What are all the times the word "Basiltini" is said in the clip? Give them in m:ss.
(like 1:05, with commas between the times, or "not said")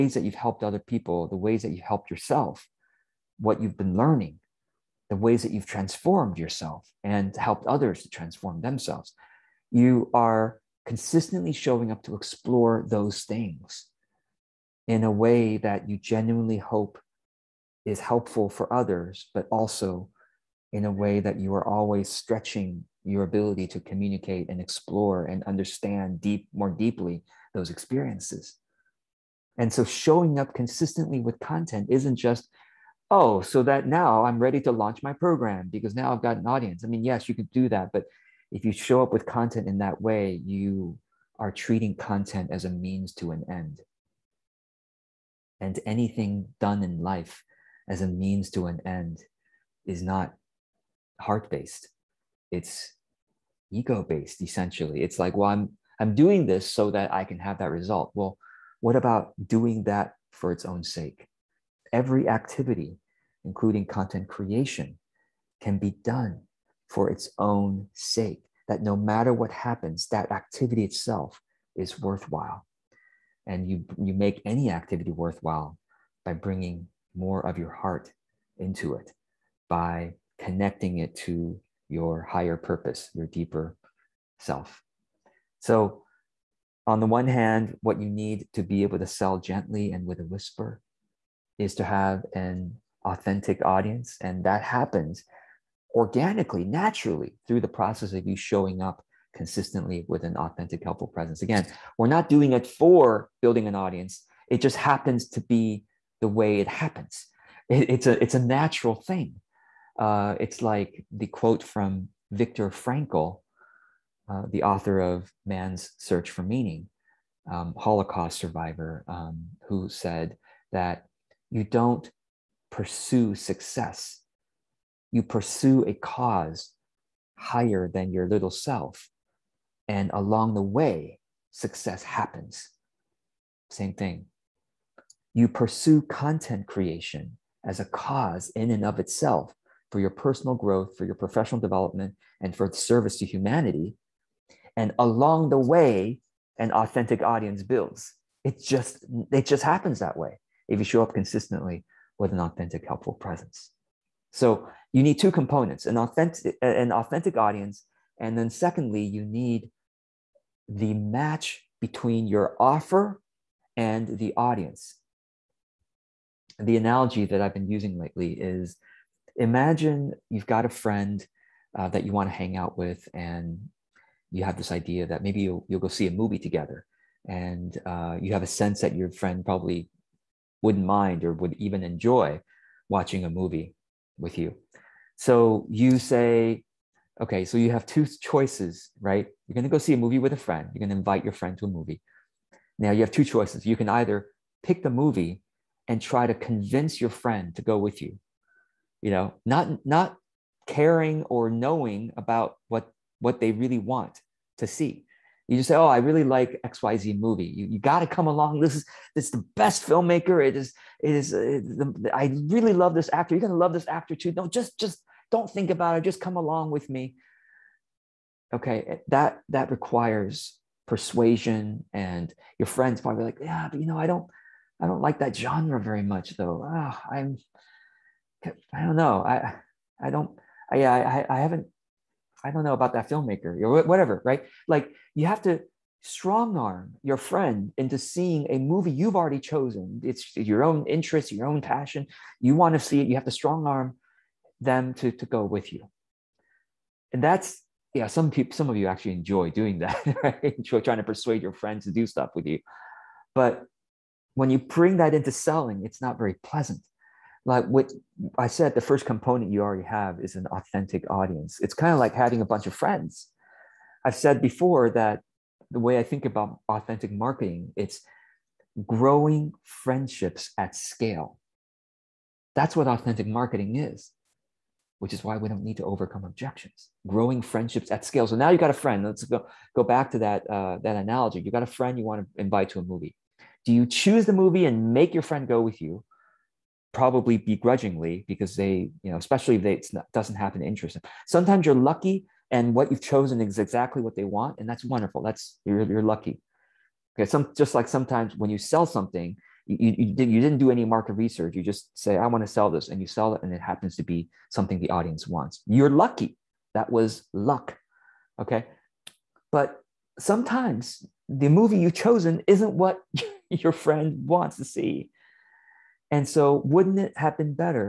not said.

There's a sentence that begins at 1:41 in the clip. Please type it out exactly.
Again, we're not doing it for building an audience, it just happens to be the way it happens.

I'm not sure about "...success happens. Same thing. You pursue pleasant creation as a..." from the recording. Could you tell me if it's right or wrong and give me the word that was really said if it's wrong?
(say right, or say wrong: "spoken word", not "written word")
wrong: "content", not "pleasant".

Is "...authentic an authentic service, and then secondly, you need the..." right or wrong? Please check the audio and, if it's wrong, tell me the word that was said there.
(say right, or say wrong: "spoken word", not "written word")
wrong: "audience", not "service".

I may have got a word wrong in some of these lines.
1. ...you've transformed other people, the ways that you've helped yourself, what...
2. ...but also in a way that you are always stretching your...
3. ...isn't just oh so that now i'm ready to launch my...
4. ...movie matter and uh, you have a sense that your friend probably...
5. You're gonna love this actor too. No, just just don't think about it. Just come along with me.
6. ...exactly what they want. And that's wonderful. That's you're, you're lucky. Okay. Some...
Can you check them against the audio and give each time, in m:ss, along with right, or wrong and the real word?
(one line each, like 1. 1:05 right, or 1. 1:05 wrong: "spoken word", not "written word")
1. 0:00 wrong: "helped", not "transformed"
2. 0:19 right
3. 0:31 right
4. 2:56 wrong: "together", not "matter"
5. 3:33 right
6. 4:53 right.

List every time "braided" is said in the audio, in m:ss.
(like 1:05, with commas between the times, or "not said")
not said.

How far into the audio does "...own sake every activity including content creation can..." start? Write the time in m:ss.
1:00.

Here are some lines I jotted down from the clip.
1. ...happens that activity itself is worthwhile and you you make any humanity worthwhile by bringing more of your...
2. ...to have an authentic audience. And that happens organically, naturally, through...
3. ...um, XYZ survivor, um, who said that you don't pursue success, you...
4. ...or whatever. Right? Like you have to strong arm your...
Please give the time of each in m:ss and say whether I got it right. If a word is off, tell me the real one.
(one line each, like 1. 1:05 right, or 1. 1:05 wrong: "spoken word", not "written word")
1. 1:09 wrong: "activity", not "humanity"
2. 1:31 right
3. 1:57 wrong: "Holocaust", not "XYZ"
4. 3:53 right.